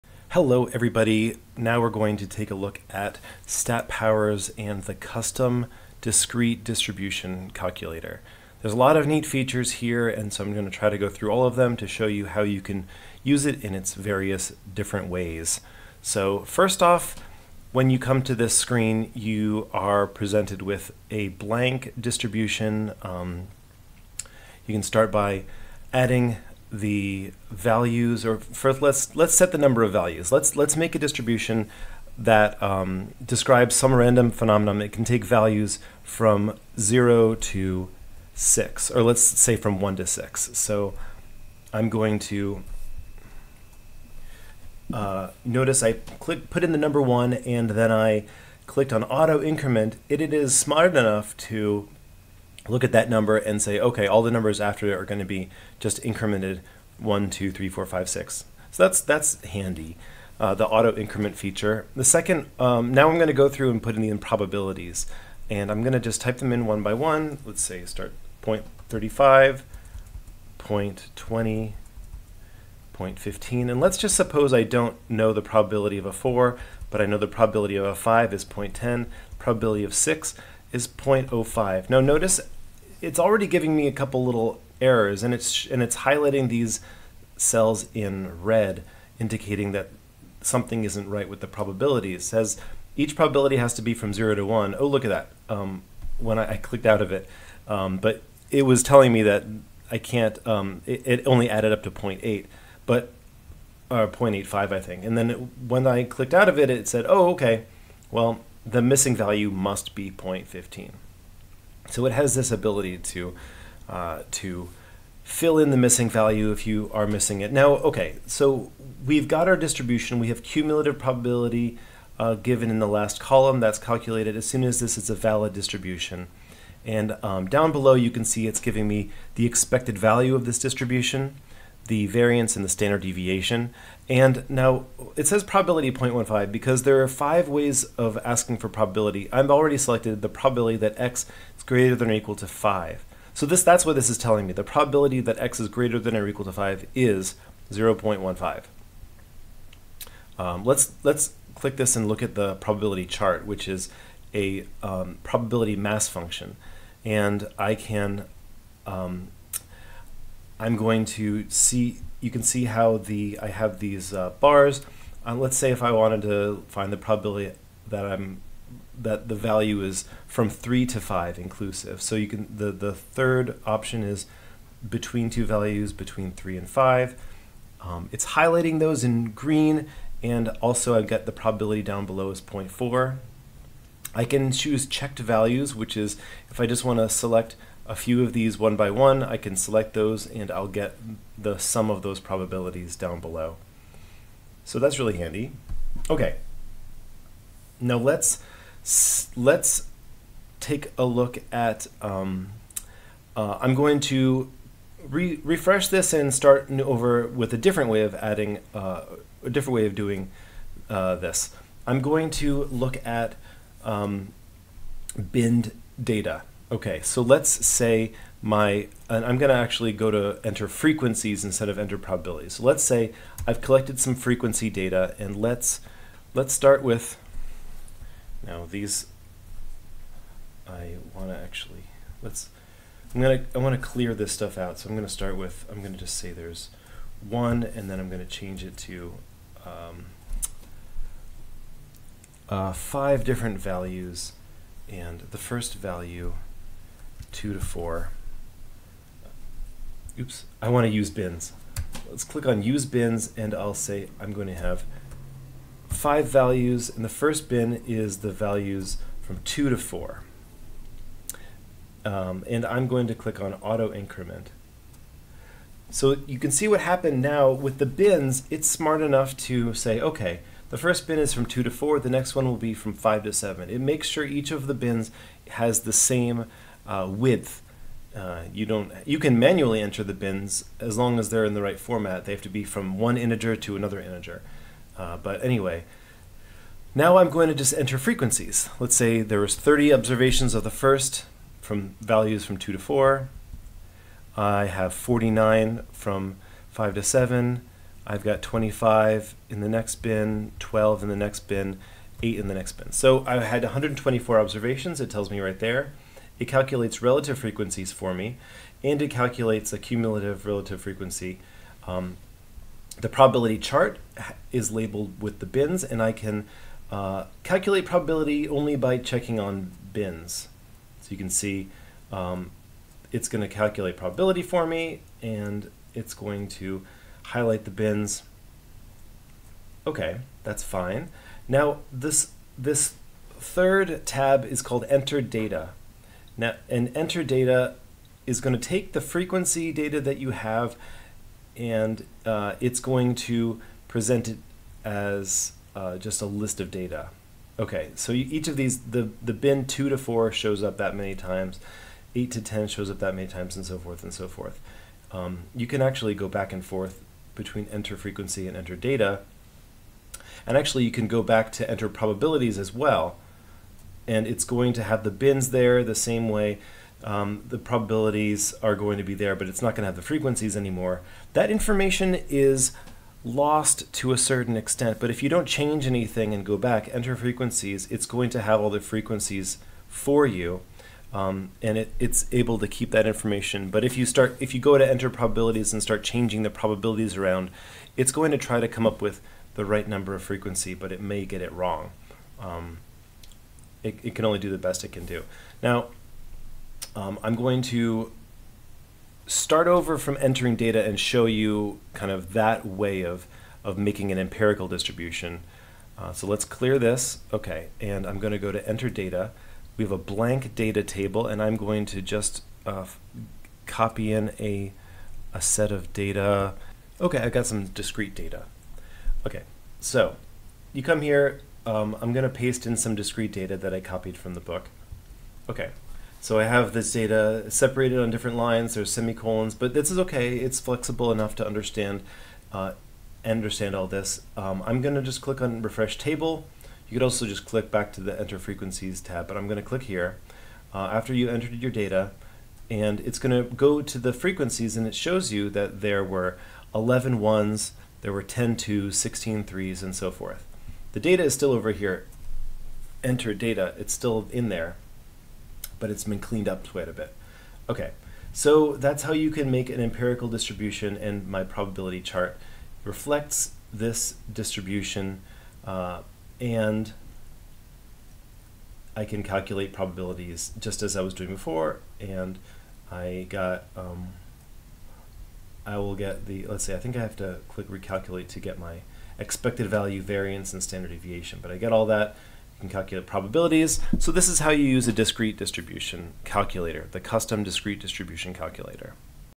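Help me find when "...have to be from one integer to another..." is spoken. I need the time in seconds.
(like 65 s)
282 s.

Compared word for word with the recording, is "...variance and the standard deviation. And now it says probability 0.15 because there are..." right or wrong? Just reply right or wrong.
right.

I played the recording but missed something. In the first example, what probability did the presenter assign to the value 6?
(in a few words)
0.05.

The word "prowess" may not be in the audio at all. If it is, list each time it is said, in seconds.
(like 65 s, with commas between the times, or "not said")
not said.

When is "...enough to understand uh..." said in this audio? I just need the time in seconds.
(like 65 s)
431 s.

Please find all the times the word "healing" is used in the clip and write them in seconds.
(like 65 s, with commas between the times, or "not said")
not said.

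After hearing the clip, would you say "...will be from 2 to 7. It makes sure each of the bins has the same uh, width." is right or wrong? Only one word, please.
wrong.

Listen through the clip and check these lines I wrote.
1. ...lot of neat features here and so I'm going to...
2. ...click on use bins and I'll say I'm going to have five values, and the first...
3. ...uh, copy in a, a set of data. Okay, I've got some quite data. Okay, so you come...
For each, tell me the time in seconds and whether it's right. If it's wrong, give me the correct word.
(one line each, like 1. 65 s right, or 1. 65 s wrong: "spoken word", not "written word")
1. 8 s right
2. 252 s right
3. 412 s wrong: "discrete", not "quite".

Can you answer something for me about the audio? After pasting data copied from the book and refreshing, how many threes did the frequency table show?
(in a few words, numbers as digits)
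16.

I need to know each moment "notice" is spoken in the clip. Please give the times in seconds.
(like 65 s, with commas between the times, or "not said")
45 s, 81 s.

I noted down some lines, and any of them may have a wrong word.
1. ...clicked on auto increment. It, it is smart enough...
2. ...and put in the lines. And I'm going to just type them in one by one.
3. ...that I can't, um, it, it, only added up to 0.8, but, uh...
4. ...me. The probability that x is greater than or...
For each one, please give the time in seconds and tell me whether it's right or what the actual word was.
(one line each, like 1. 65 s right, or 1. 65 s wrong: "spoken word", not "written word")
1. 48 s right
2. 63 s wrong: "improbabilities", not "lines"
3. 99 s right
4. 144 s right.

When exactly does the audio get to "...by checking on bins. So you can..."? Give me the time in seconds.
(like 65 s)
318 s.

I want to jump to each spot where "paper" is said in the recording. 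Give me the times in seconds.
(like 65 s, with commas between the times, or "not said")
not said.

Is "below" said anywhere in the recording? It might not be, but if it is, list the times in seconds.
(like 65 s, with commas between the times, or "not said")
127 s, 182 s, 193 s.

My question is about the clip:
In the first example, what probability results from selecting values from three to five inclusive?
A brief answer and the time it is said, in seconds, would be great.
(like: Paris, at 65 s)
0.4, at 182 s.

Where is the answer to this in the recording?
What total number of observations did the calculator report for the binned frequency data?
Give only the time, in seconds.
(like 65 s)
303 s.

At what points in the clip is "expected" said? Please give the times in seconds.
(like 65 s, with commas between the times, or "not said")
129 s, 479 s.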